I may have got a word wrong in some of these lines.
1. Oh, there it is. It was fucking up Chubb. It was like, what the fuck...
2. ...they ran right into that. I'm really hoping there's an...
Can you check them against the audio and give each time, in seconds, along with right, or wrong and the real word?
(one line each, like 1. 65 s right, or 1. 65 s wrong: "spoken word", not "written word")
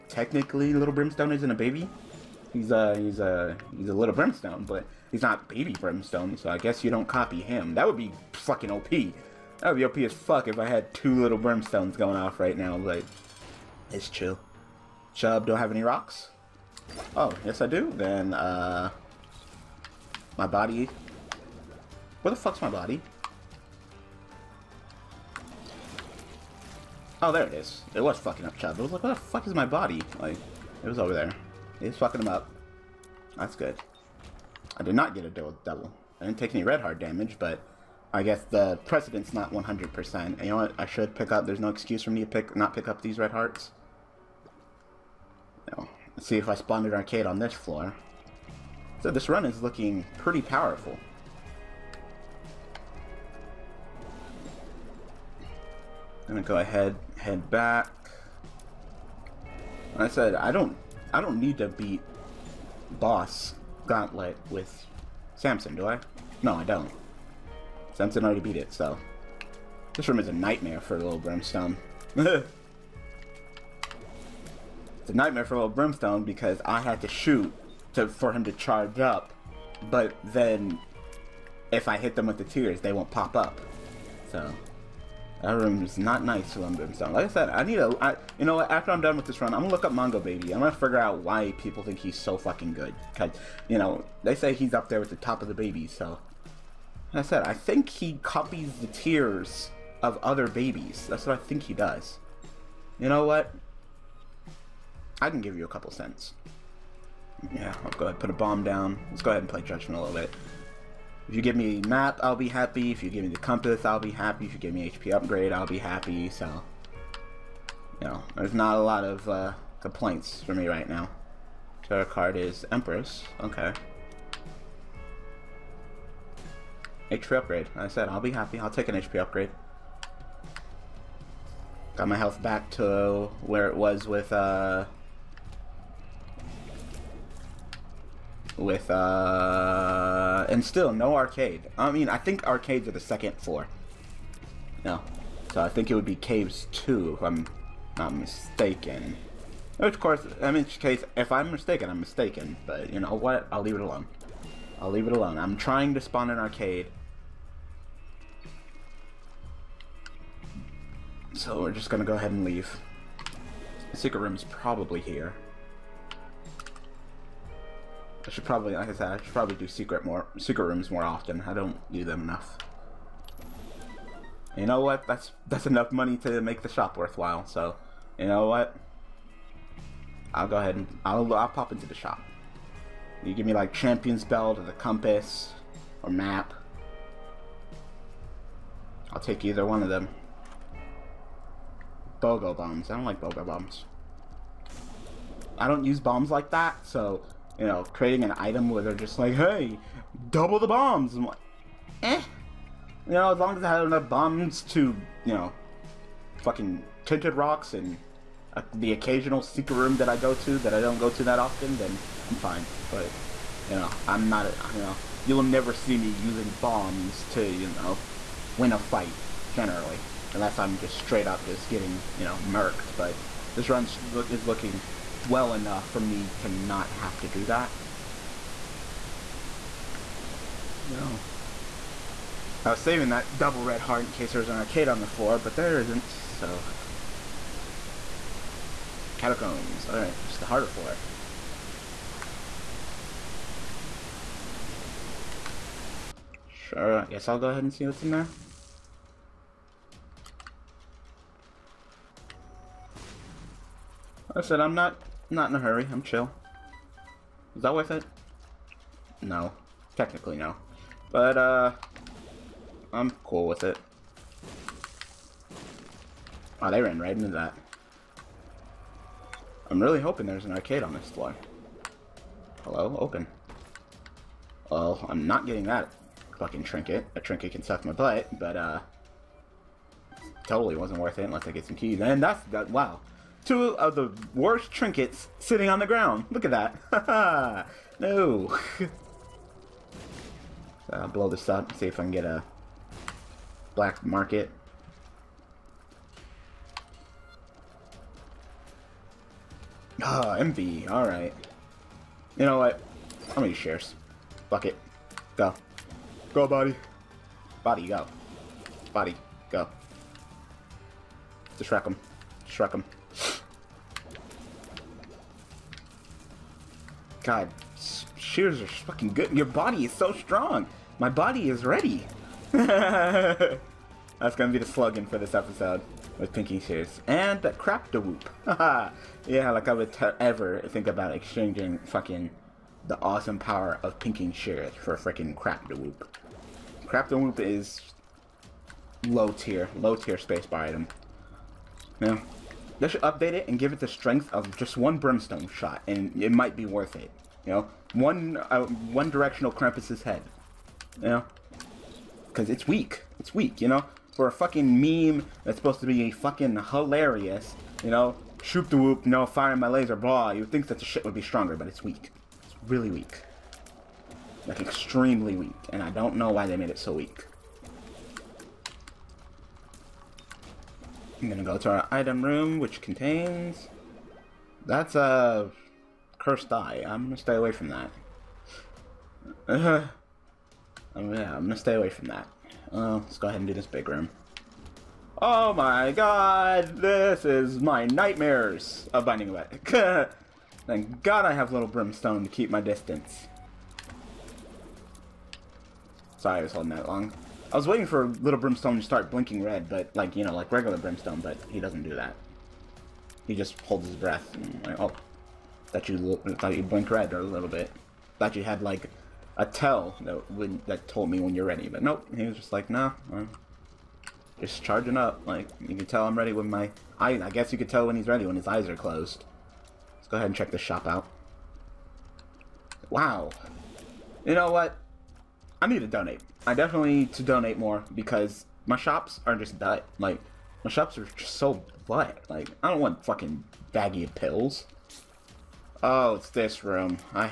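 1. 27 s right
2. 266 s right.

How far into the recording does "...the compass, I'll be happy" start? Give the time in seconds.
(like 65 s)
113 s.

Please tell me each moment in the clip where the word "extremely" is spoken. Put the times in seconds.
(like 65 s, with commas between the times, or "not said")
364 s.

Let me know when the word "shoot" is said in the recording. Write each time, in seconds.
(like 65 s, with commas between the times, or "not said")
77 s, 358 s.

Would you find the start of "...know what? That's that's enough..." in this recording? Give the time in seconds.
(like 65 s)
174 s.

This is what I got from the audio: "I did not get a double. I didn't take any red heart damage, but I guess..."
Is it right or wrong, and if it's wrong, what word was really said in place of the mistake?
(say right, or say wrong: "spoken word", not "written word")
right.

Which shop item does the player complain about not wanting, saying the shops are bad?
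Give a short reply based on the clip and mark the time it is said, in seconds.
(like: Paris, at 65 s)
Baggy pills, at 433 s.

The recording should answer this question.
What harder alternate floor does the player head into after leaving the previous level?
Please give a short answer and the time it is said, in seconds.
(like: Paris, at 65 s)
Catacombs, at 239 s.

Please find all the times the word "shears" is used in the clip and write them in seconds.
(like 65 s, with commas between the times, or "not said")
318 s, 326 s, 334 s.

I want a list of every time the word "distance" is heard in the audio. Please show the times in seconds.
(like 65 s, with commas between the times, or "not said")
392 s.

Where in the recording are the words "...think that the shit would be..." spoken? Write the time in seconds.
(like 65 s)
360 s.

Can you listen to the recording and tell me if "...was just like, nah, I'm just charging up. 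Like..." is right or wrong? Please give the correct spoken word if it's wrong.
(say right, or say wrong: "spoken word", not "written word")
right.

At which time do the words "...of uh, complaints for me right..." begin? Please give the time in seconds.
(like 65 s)
119 s.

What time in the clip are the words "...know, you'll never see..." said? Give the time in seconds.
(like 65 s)
214 s.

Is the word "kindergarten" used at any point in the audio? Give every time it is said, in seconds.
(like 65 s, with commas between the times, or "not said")
not said.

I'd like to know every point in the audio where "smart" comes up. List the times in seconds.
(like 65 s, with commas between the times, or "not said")
not said.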